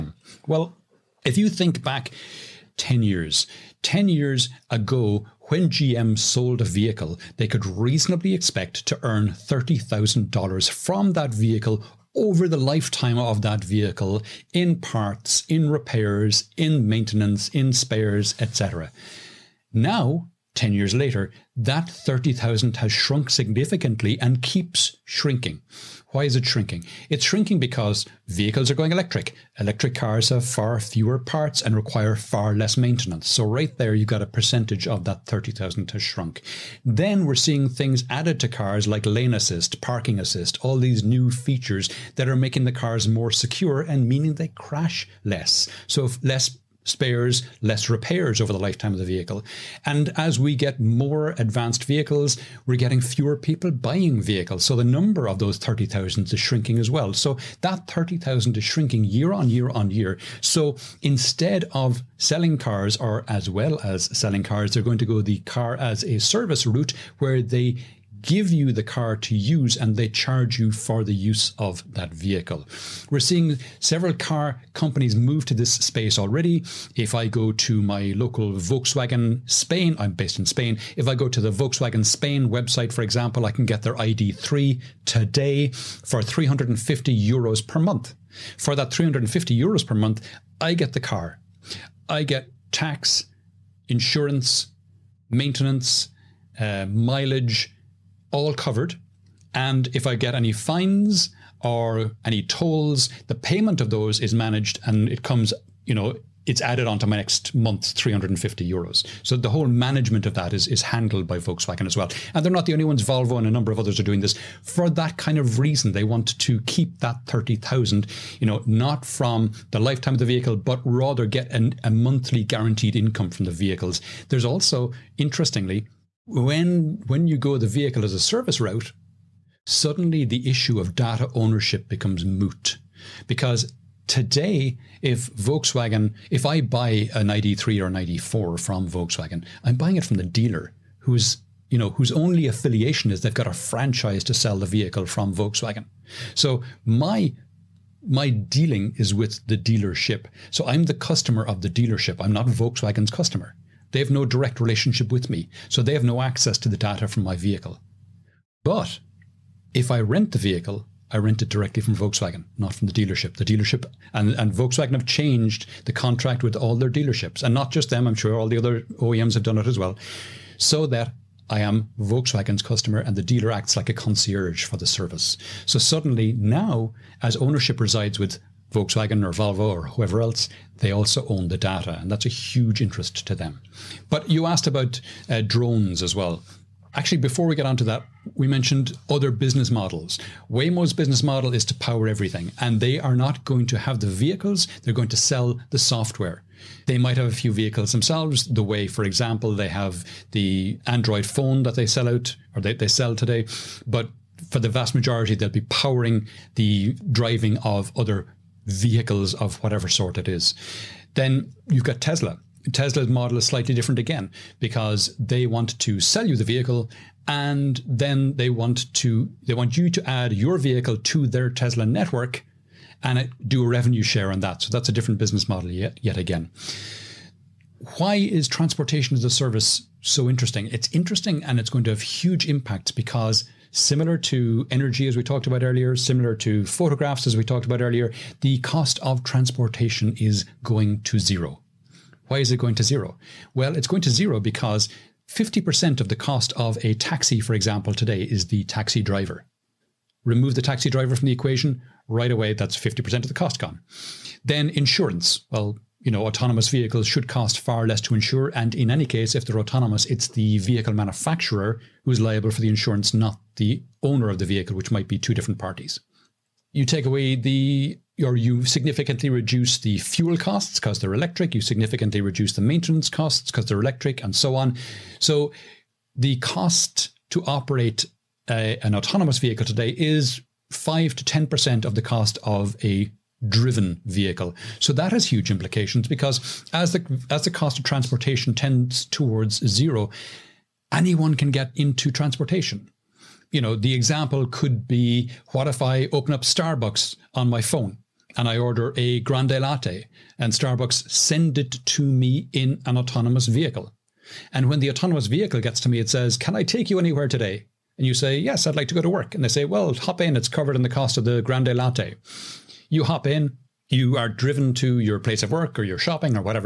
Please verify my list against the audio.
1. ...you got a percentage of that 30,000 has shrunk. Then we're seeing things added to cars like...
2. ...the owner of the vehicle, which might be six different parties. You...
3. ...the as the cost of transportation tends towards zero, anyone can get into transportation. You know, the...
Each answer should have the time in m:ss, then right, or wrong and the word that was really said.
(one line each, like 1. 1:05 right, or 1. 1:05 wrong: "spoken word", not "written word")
1. 0:33 right
2. 4:23 wrong: "two", not "six"
3. 4:46 right.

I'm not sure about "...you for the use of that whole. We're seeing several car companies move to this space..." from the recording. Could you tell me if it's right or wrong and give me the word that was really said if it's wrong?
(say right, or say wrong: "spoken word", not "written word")
wrong: "vehicle", not "whole".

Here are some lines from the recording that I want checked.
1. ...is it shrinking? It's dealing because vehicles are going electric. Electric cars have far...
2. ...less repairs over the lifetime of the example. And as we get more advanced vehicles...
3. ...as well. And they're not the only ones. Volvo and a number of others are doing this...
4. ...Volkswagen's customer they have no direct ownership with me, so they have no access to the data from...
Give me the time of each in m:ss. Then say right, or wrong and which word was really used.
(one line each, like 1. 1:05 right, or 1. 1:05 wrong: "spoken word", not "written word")
1. 0:26 wrong: "shrinking", not "dealing"
2. 0:47 wrong: "vehicle", not "example"
3. 1:51 right
4. 2:32 wrong: "relationship", not "ownership".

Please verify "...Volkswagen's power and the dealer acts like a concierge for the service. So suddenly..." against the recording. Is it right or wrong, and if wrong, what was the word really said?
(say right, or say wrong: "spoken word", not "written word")
wrong: "customer", not "power".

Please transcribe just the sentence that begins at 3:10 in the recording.
Waymo's business model is to power everything, and they are not going to have the vehicles, they're going to sell the software.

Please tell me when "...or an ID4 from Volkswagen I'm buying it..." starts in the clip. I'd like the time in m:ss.
2:17.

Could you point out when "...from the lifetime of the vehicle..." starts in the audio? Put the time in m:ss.
1:59.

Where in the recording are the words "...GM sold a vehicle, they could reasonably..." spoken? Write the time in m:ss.
0:05.